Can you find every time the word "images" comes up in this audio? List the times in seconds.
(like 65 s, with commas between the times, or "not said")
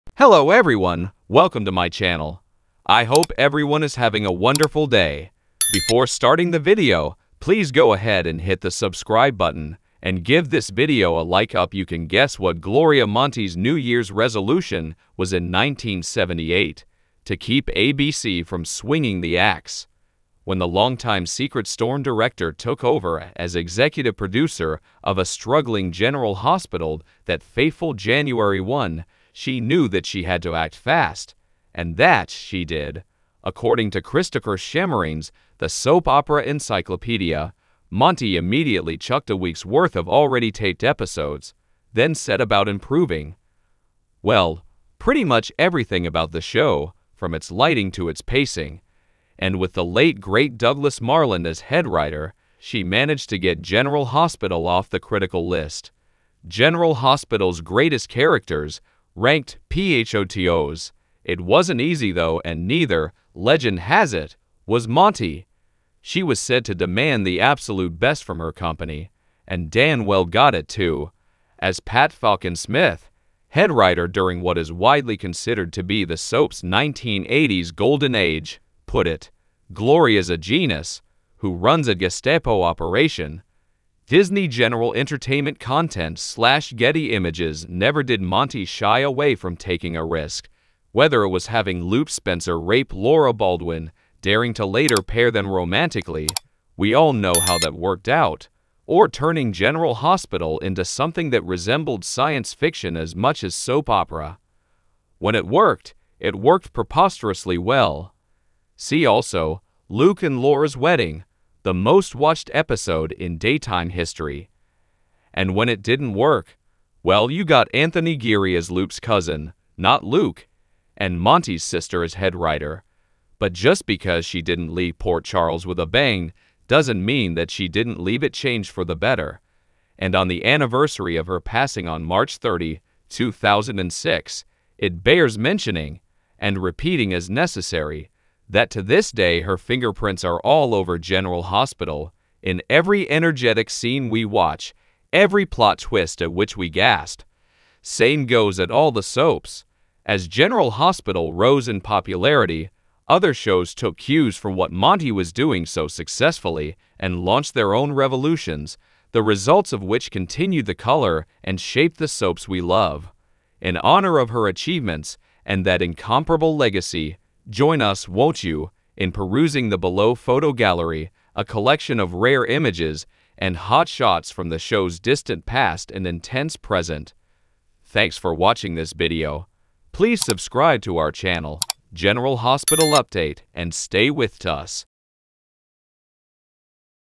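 87 s, 172 s.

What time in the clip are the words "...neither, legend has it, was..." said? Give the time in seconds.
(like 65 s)
62 s.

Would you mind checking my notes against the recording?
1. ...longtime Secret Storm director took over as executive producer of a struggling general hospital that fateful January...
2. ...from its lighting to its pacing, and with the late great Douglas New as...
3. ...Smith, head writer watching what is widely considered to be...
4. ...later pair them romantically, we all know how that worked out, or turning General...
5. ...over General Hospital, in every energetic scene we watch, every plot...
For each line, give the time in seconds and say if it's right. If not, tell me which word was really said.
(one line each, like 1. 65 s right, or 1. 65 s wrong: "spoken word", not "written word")
1. 20 s right
2. 47 s wrong: "Marland", not "New"
3. 72 s wrong: "during", not "watching"
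4. 94 s right
5. 140 s right.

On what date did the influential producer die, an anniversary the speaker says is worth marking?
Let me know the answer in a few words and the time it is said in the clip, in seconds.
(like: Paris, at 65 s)
March 30, 2006, at 132 s.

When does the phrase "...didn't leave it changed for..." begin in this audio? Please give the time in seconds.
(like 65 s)
127 s.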